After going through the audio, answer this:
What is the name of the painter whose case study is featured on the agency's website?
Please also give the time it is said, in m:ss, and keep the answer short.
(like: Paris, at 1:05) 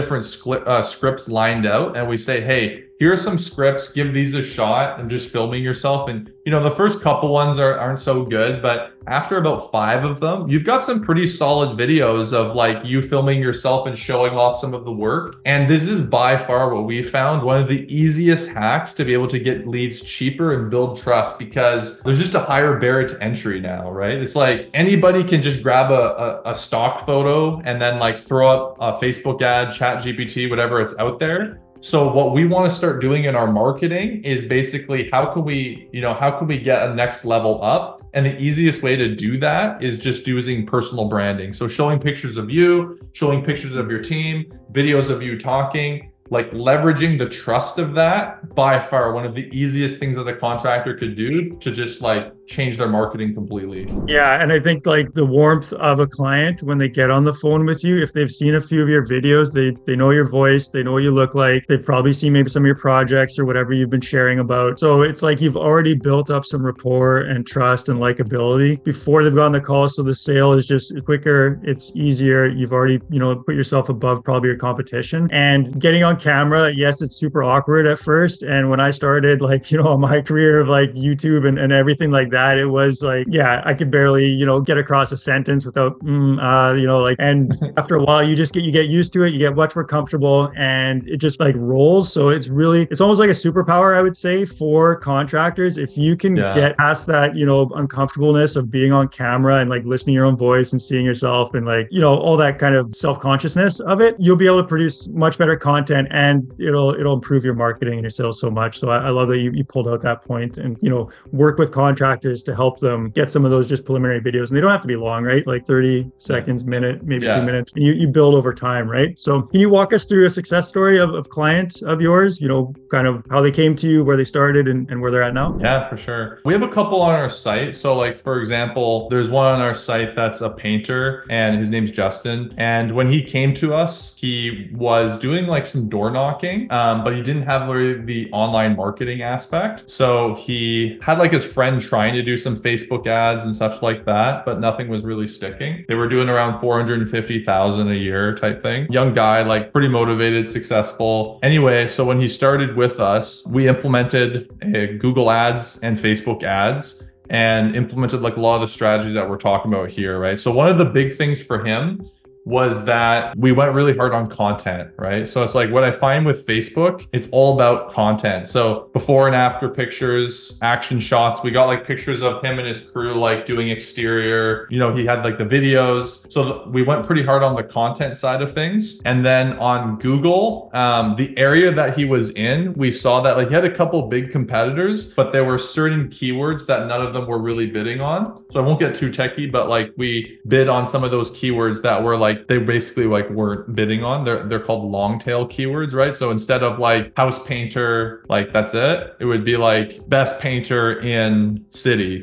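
Justin, at 2:11.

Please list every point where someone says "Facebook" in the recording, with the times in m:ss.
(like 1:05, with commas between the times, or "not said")
0:29, 2:22, 2:35, 2:46.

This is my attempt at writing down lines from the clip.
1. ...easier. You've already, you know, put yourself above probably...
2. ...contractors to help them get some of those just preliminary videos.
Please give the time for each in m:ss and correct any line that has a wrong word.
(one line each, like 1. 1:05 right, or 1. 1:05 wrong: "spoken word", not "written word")
1. 1:11 right
2. 1:52 wrong: "directors", not "contractors".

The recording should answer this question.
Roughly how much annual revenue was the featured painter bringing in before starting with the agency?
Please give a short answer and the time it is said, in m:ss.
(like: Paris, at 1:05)
450,000, at 2:26.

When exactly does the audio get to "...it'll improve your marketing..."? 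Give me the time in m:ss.
1:46.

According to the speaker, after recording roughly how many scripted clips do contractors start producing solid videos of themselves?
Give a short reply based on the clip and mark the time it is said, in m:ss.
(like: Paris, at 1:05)
5, at 0:09.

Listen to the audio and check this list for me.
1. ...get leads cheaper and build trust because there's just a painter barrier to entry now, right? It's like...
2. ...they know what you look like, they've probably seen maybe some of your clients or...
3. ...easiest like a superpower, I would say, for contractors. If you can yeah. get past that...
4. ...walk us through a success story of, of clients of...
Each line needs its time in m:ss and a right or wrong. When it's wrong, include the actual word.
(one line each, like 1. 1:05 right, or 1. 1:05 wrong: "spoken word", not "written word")
1. 0:19 wrong: "higher", not "painter"
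2. 1:00 wrong: "projects", not "clients"
3. 1:33 wrong: "almost", not "easiest"
4. 1:59 right.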